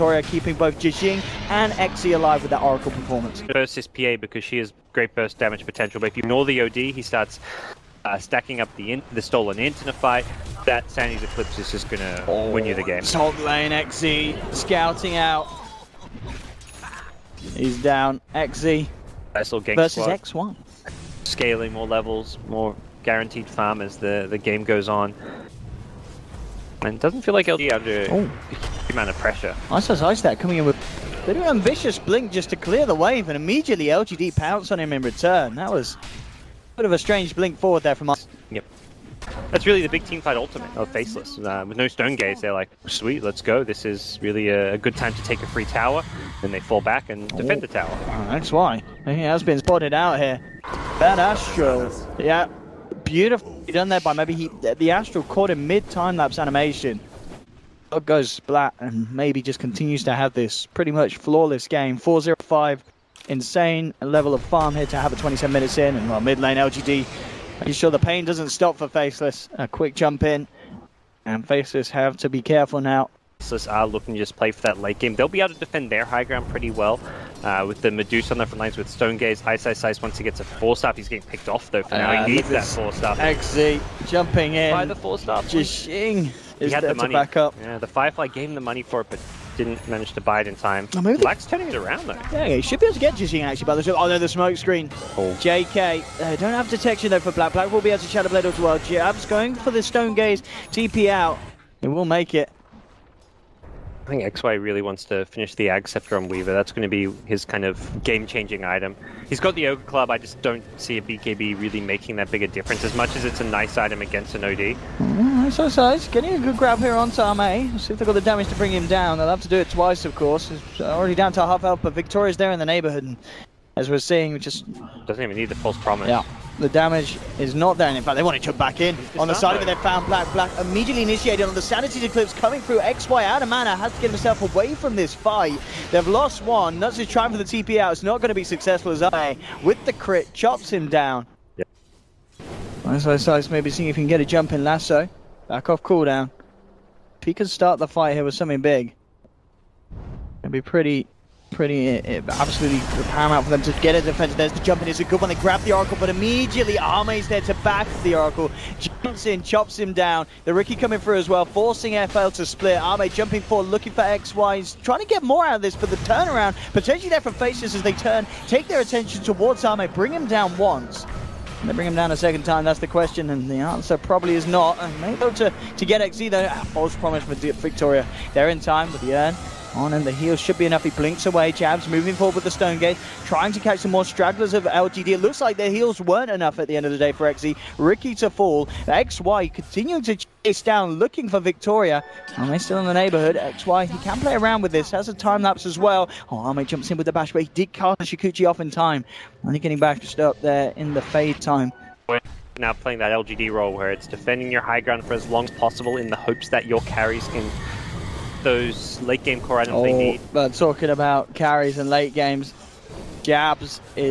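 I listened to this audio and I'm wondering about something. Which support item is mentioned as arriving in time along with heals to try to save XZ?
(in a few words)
urn.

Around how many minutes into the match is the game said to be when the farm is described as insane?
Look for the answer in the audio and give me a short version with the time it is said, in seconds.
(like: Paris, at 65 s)
27, at 65 s.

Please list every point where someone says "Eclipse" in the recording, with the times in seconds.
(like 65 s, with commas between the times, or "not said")
11 s, 132 s.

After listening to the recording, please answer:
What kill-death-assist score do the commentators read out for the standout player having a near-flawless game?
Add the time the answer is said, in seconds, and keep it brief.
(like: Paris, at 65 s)
4-0-5, at 61 s.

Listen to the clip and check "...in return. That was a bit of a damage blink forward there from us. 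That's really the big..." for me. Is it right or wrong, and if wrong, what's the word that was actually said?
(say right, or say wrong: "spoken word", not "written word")
wrong: "strange", not "damage".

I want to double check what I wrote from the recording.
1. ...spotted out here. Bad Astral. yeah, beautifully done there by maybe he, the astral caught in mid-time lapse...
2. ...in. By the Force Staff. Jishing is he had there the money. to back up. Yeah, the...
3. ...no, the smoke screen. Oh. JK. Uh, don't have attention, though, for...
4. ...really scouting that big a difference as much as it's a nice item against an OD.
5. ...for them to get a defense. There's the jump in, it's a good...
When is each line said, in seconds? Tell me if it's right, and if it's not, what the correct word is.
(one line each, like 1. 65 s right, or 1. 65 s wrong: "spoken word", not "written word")
1. 49 s right
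2. 84 s right
3. 94 s wrong: "detection", not "attention"
4. 111 s wrong: "making", not "scouting"
5. 153 s right.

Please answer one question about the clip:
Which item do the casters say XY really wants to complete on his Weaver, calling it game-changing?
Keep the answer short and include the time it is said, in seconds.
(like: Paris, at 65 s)
Ag Scepter, at 105 s.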